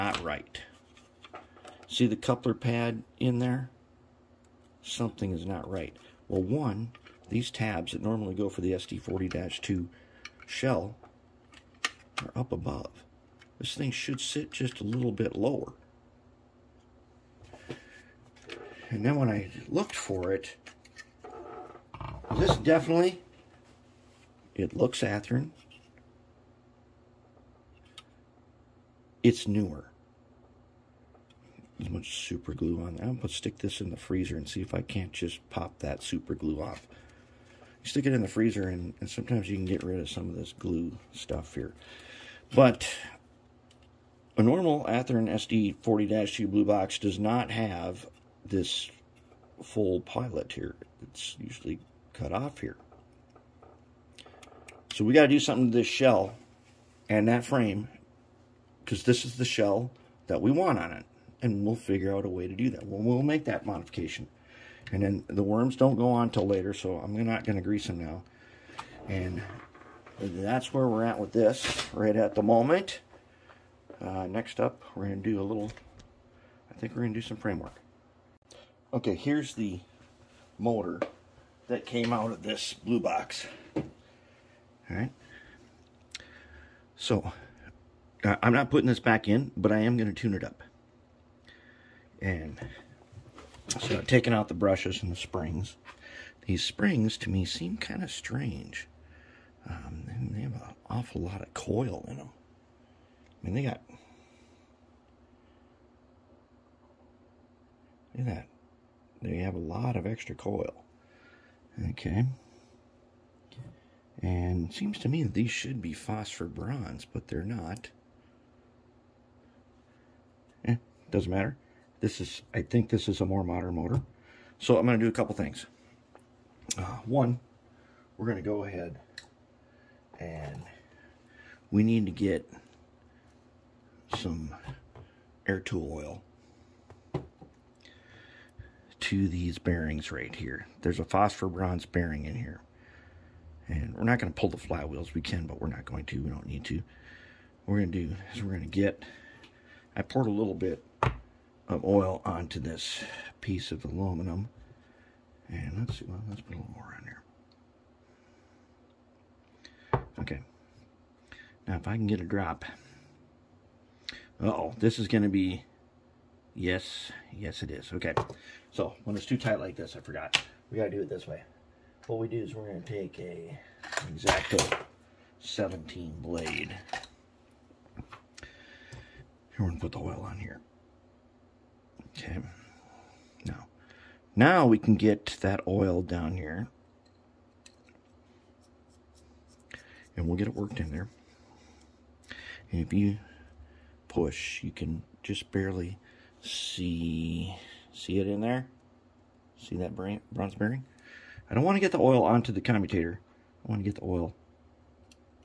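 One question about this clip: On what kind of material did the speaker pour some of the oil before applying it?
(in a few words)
Aluminum.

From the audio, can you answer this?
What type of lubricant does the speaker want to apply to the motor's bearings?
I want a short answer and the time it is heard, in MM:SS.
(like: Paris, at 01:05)
Air tool oil, at 02:15.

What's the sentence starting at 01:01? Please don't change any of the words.
And we'll figure out a way to do that.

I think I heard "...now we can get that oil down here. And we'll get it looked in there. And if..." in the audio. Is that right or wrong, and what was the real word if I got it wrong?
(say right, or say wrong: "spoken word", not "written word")
wrong: "worked", not "looked".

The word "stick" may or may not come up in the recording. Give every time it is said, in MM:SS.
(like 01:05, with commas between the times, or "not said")
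00:33, 00:37.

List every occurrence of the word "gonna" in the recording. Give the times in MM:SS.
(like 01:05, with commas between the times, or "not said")
02:52, 02:59.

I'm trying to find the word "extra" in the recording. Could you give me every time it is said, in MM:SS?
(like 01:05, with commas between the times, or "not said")
01:50.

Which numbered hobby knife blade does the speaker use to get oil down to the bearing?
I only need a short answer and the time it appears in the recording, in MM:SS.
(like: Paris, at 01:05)
Exacto 17, at 02:54.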